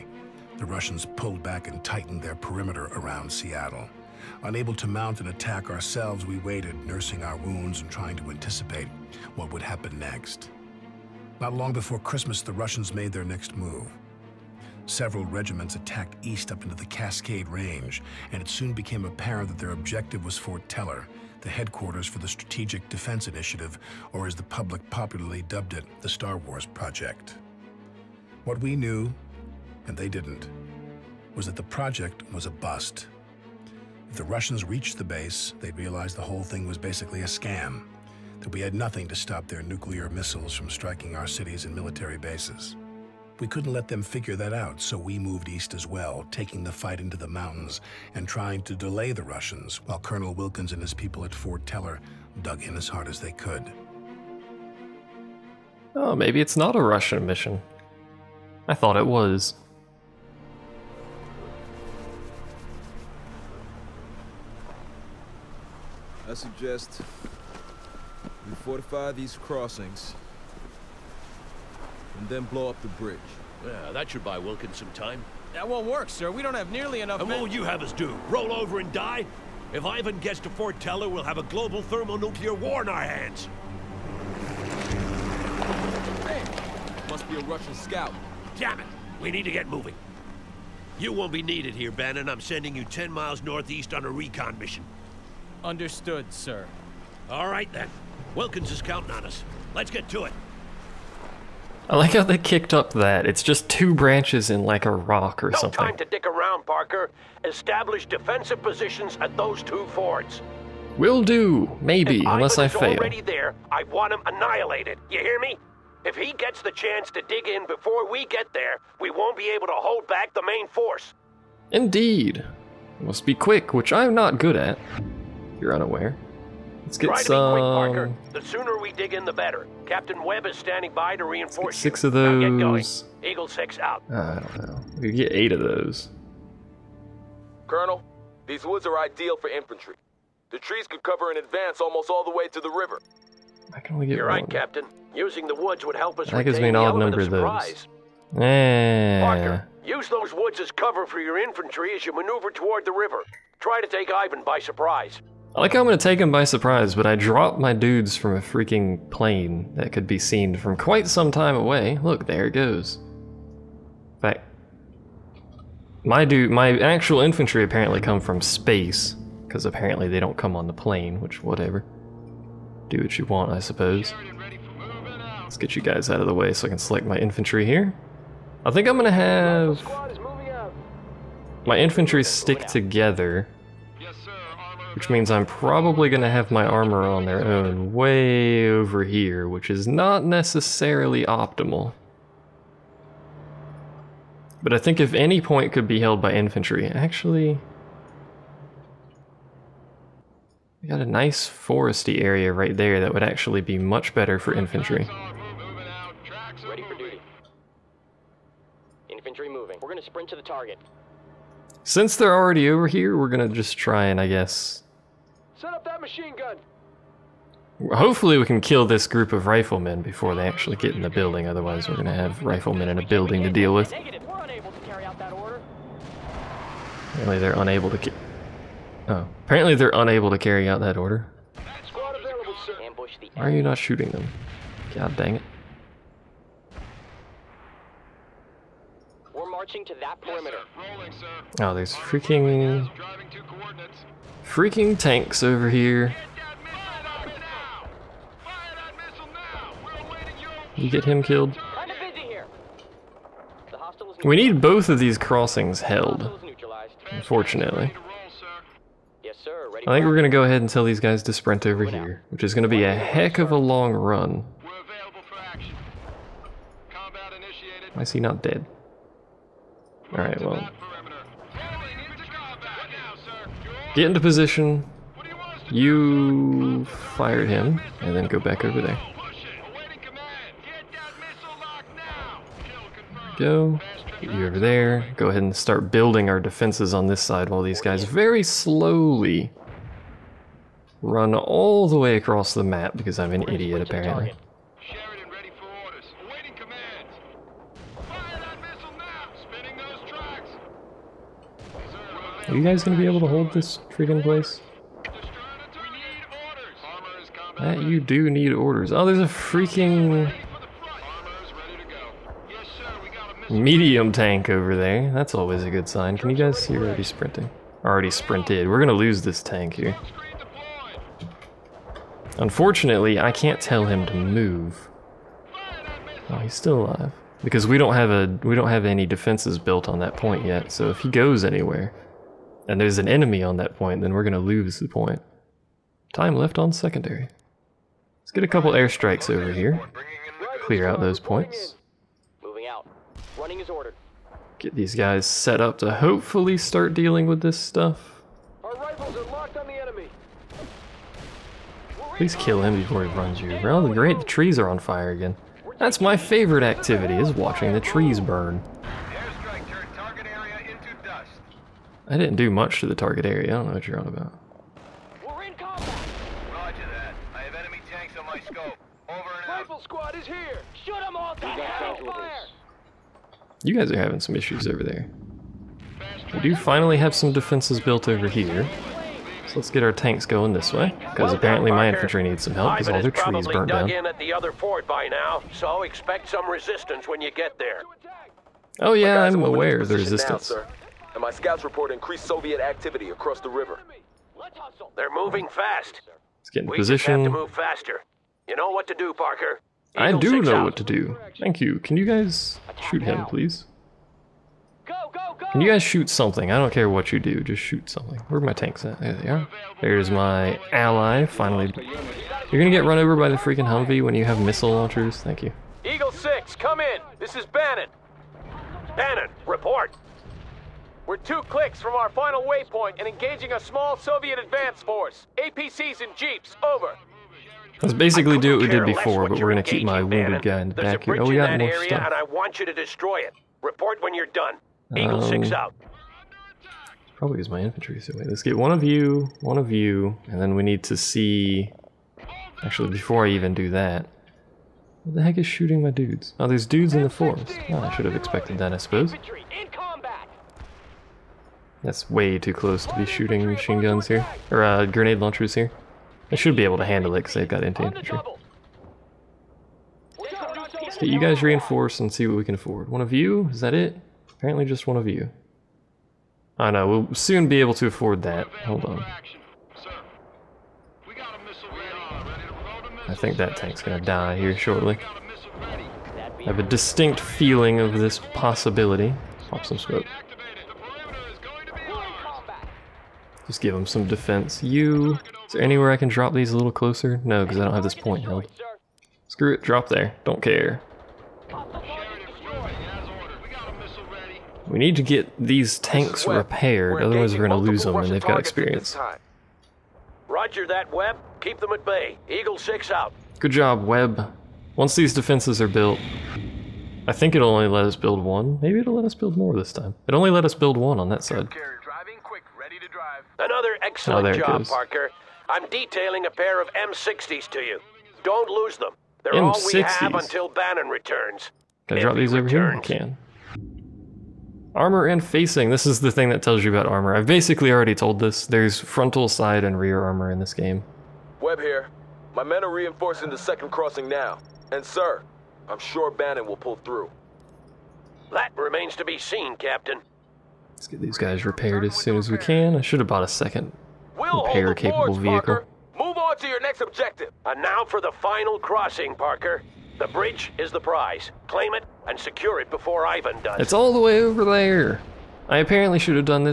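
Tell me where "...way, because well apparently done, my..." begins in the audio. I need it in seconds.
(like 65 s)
380 s.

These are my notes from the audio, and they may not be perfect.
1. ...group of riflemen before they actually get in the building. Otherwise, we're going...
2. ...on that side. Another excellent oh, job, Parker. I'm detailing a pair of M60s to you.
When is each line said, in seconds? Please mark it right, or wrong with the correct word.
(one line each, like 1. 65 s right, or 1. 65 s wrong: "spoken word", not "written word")
1. 219 s right
2. 510 s right.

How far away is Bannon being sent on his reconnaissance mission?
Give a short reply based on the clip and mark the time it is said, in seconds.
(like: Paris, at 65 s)
10 miles, at 92 s.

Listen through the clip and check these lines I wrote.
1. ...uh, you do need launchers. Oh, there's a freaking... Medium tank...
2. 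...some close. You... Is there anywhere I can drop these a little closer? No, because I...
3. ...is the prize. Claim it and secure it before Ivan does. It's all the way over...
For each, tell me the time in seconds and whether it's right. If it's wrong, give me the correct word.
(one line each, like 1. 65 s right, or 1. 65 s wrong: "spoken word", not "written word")
1. 307 s wrong: "orders", not "launchers"
2. 483 s wrong: "defense", not "close"
3. 550 s right.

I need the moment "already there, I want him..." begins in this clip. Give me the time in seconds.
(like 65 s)
112 s.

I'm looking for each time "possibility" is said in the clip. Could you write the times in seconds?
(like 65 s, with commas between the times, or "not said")
478 s.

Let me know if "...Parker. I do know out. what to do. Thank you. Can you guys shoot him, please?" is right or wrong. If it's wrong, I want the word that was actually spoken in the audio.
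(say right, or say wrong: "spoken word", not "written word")
right.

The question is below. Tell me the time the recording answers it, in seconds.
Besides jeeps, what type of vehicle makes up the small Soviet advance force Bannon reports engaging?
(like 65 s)
425 s.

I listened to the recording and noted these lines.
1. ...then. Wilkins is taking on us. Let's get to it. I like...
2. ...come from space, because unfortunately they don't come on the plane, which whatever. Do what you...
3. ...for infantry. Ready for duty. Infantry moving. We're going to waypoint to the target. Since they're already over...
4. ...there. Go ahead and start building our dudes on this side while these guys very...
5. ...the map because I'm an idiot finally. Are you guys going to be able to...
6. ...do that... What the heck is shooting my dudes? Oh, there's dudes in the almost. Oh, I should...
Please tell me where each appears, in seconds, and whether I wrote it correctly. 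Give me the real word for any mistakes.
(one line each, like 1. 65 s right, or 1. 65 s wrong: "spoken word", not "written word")
1. 97 s wrong: "counting", not "taking"
2. 168 s wrong: "apparently", not "unfortunately"
3. 204 s wrong: "sprint", not "waypoint"
4. 284 s wrong: "defenses", not "dudes"
5. 292 s wrong: "apparently", not "finally"
6. 443 s wrong: "forest", not "almost".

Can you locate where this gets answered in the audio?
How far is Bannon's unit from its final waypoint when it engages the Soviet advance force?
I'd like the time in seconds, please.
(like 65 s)
421 s.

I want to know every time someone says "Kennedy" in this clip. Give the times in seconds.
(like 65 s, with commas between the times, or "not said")
not said.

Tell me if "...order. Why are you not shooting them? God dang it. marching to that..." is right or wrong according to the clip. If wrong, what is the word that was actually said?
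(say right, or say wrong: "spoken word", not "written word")
right.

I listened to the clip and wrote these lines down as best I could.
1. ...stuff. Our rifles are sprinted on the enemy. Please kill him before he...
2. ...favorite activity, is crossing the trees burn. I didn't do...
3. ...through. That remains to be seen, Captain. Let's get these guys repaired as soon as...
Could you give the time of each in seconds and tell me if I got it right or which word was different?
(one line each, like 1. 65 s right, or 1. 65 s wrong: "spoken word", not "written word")
1. 347 s wrong: "locked", not "sprinted"
2. 356 s wrong: "watching", not "crossing"
3. 536 s right.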